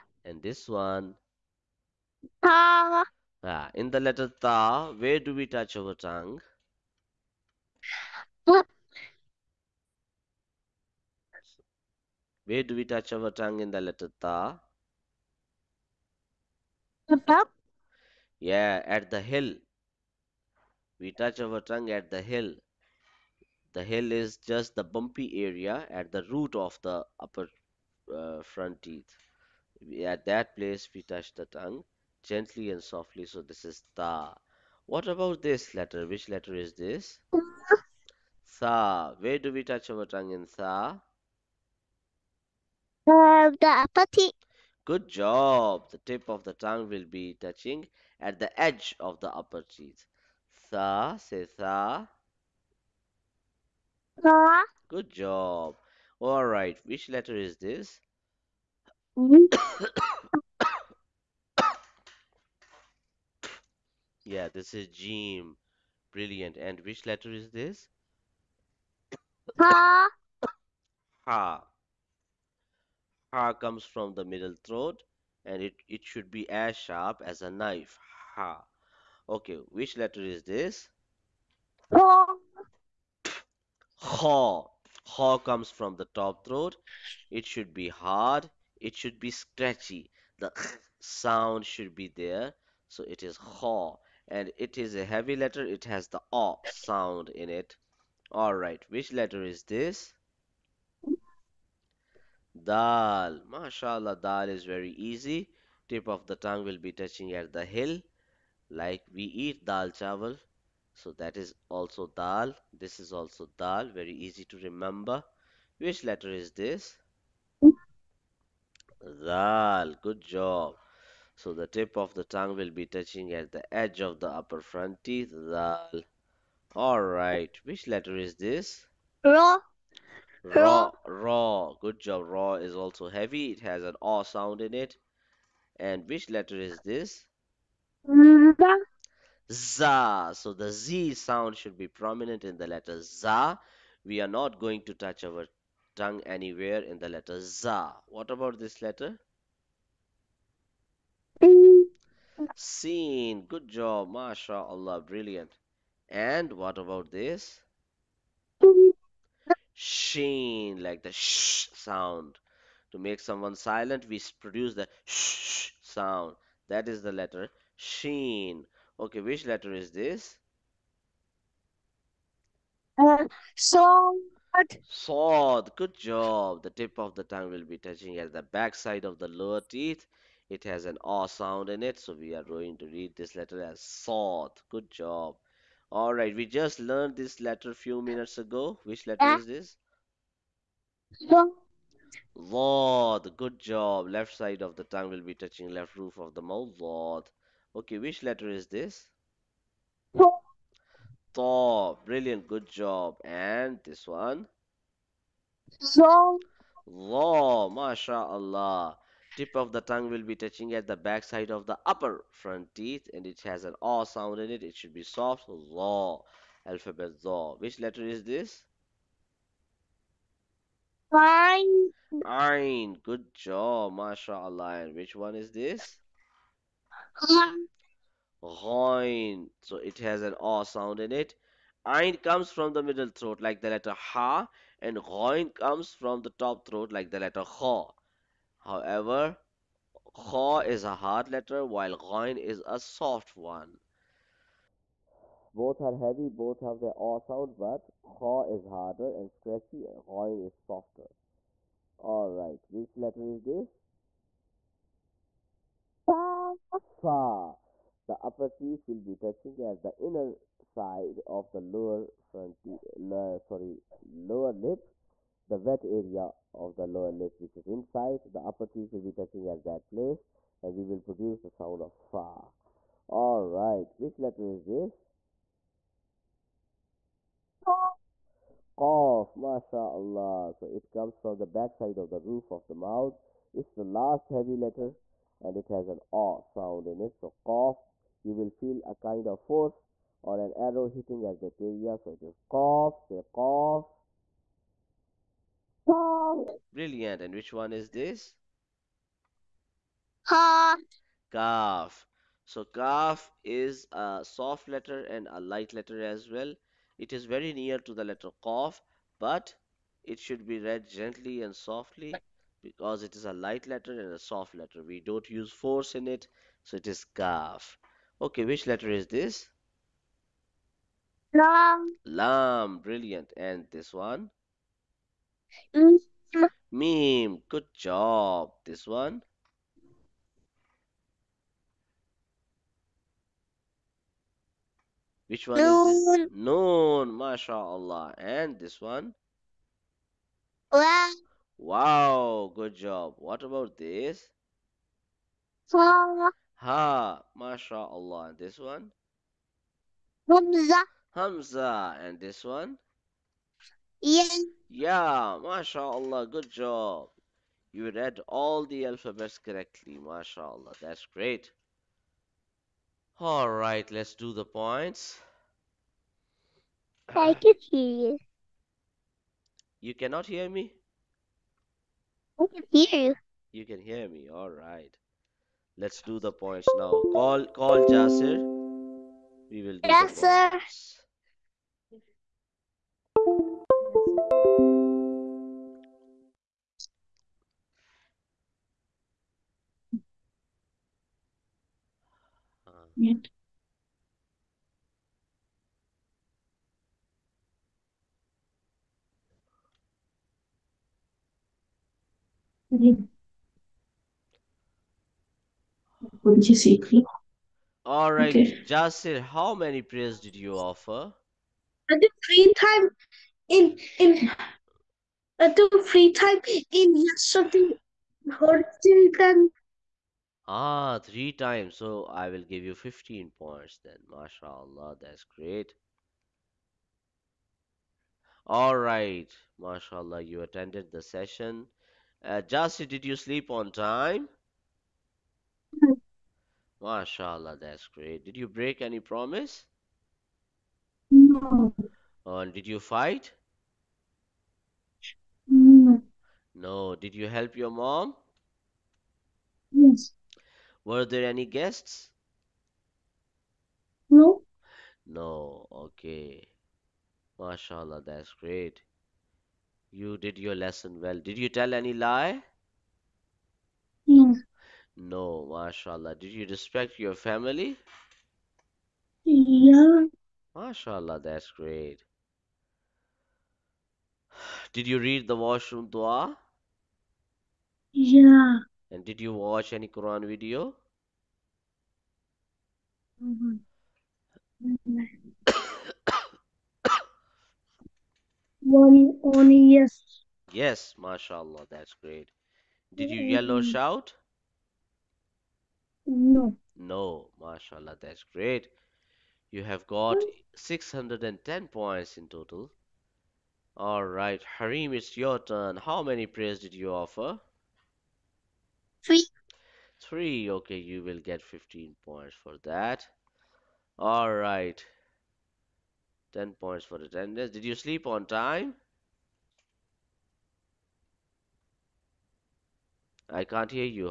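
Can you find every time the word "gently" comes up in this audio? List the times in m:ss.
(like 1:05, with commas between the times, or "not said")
0:32, 5:10.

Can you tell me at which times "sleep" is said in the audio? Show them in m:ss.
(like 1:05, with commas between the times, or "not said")
7:13, 8:37.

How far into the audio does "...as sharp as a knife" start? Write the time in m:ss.
1:16.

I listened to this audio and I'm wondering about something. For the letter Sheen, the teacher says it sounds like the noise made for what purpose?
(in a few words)
to make someone silent.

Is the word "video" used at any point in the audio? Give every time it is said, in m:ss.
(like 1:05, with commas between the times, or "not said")
8:00.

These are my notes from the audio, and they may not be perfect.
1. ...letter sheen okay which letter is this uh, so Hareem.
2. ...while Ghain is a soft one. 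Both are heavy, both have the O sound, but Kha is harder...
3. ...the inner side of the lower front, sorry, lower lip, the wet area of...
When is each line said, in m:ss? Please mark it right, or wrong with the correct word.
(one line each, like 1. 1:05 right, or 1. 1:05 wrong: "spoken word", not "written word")
1. 2:47 wrong: "Sword", not "Hareem"
2. 4:01 right
3. 4:19 right.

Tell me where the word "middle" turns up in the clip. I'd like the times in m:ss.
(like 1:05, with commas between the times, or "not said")
1:14, 3:52.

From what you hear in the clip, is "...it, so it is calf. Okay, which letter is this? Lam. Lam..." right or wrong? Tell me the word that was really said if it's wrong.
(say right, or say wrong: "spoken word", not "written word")
right.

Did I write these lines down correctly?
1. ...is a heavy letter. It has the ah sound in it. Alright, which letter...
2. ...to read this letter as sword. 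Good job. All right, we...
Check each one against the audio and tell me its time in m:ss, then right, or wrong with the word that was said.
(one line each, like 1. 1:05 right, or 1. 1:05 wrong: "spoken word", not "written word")
1. 1:34 right
2. 3:02 right.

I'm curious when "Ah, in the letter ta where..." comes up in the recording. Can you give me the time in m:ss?
0:03.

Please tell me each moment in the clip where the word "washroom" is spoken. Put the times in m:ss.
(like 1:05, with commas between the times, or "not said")
7:55.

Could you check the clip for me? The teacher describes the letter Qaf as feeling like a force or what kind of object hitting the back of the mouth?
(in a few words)
an arrow.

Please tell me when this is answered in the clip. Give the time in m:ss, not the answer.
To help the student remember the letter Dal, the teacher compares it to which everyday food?
1:49.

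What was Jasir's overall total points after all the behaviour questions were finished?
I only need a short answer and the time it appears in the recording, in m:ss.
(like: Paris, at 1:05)
610, at 8:20.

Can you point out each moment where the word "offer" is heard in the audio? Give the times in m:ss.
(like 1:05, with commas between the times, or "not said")
6:50, 8:26.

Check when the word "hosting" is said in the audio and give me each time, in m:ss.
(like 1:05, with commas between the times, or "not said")
not said.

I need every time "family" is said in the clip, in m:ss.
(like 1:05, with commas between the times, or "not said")
7:47.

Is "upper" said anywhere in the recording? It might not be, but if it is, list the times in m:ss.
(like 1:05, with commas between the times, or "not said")
0:27, 0:49, 2:04, 3:31, 4:18, 4:28.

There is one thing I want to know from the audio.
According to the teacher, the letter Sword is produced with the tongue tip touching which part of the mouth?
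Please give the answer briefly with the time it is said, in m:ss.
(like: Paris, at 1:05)
backside of the lower teeth, at 2:58.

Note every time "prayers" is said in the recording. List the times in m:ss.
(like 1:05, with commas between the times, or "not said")
6:49, 8:26.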